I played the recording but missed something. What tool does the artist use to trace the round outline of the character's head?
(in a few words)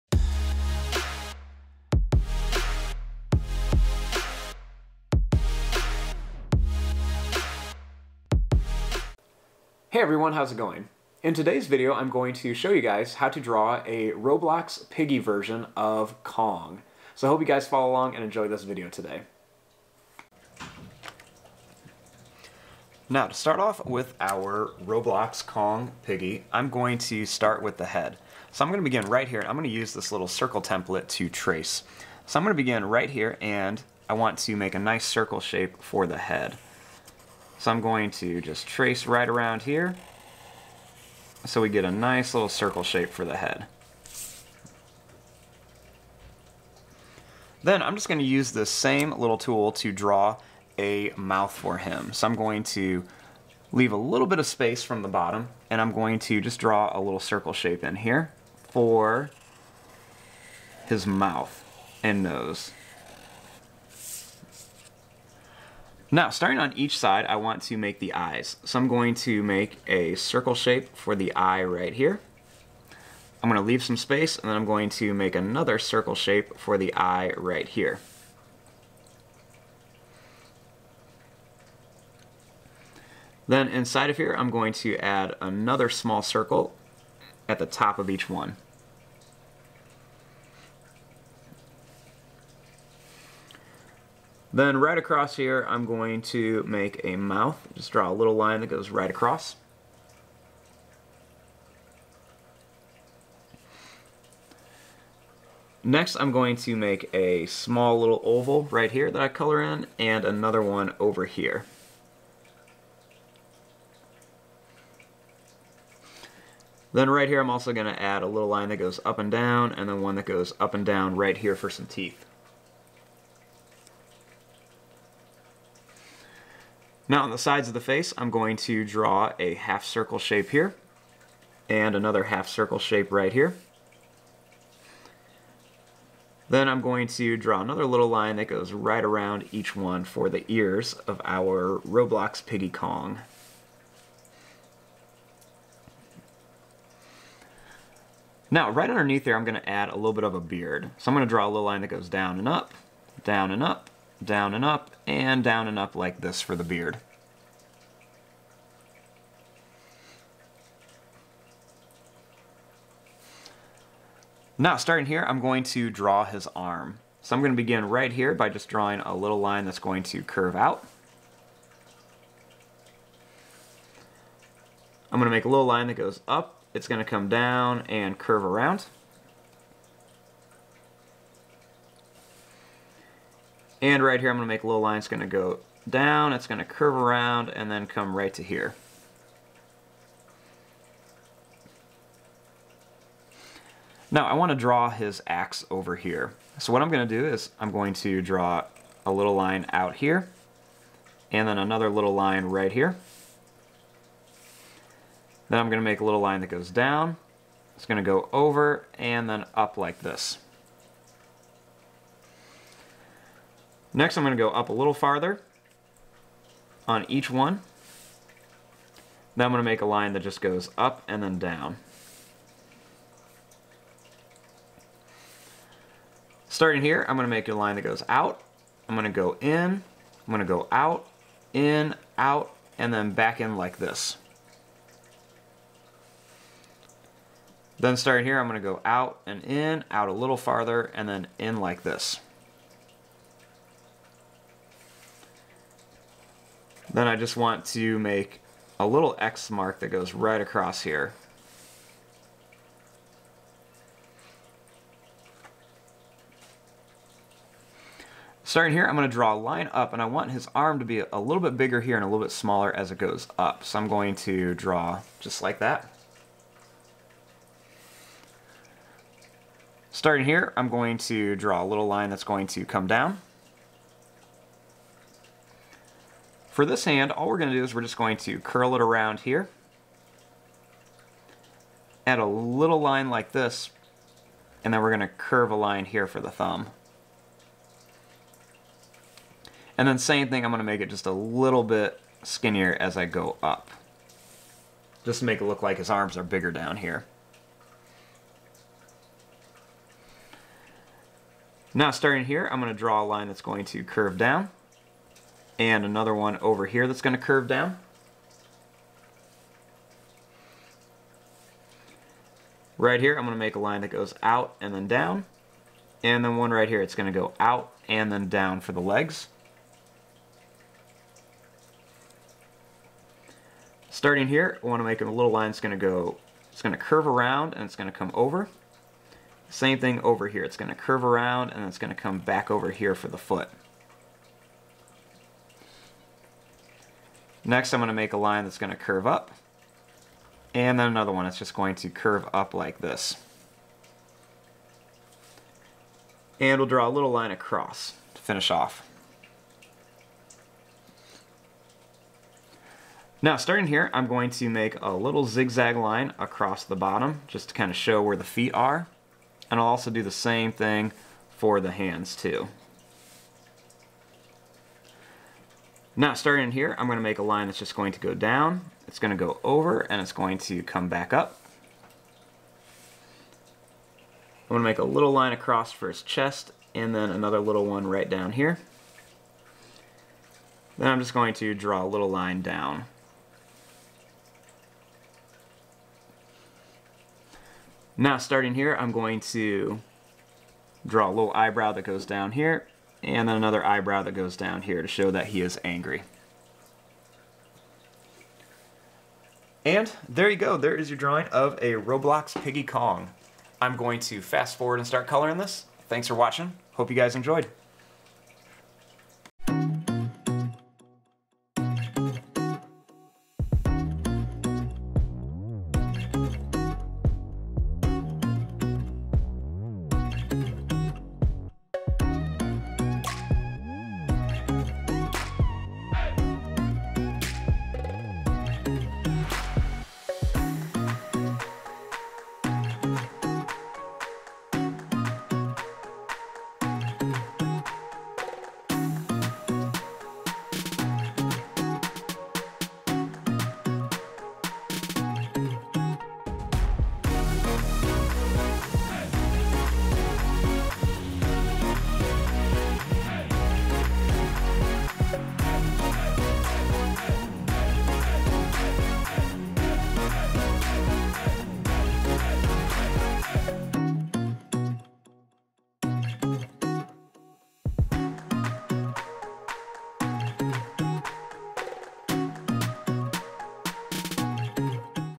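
circle template.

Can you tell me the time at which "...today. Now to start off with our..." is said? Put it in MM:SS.
00:18.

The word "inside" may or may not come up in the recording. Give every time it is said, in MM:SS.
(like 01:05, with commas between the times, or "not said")
01:23.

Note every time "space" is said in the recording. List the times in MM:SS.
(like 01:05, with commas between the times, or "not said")
00:54, 01:13.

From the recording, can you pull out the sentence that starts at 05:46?
And we'll draw a little line across to finish off.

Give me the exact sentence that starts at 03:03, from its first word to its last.
And right here, I'm gonna make a little line.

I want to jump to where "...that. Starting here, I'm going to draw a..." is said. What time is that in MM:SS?
04:25.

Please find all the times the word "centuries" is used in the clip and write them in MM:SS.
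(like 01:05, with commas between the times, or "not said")
not said.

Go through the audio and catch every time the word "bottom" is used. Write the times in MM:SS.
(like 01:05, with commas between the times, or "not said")
00:55, 05:56.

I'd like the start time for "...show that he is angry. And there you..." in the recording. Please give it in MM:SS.
06:34.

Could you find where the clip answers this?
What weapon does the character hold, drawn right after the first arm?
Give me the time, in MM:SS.
03:15.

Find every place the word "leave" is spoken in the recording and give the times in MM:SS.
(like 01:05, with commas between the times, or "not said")
00:53, 01:13.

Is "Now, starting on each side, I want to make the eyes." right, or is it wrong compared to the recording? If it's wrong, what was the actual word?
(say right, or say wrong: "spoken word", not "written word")
right.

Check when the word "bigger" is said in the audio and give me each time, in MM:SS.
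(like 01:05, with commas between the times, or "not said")
04:21, 04:56.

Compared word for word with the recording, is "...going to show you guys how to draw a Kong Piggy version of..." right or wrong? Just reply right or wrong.
wrong.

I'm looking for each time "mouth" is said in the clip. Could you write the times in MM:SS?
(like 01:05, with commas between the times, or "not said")
00:51, 01:01, 01:37.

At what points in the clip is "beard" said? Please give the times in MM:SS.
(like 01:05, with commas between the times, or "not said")
02:30, 02:36.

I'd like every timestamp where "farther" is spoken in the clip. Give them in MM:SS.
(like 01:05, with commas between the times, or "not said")
03:34, 04:00.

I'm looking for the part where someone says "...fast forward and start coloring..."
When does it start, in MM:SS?
06:44.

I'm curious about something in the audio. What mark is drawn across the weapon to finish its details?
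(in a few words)
X mark.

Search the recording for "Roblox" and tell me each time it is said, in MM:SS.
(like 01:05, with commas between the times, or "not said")
00:14, 00:24, 02:21, 06:41.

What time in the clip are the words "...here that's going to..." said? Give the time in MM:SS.
05:06.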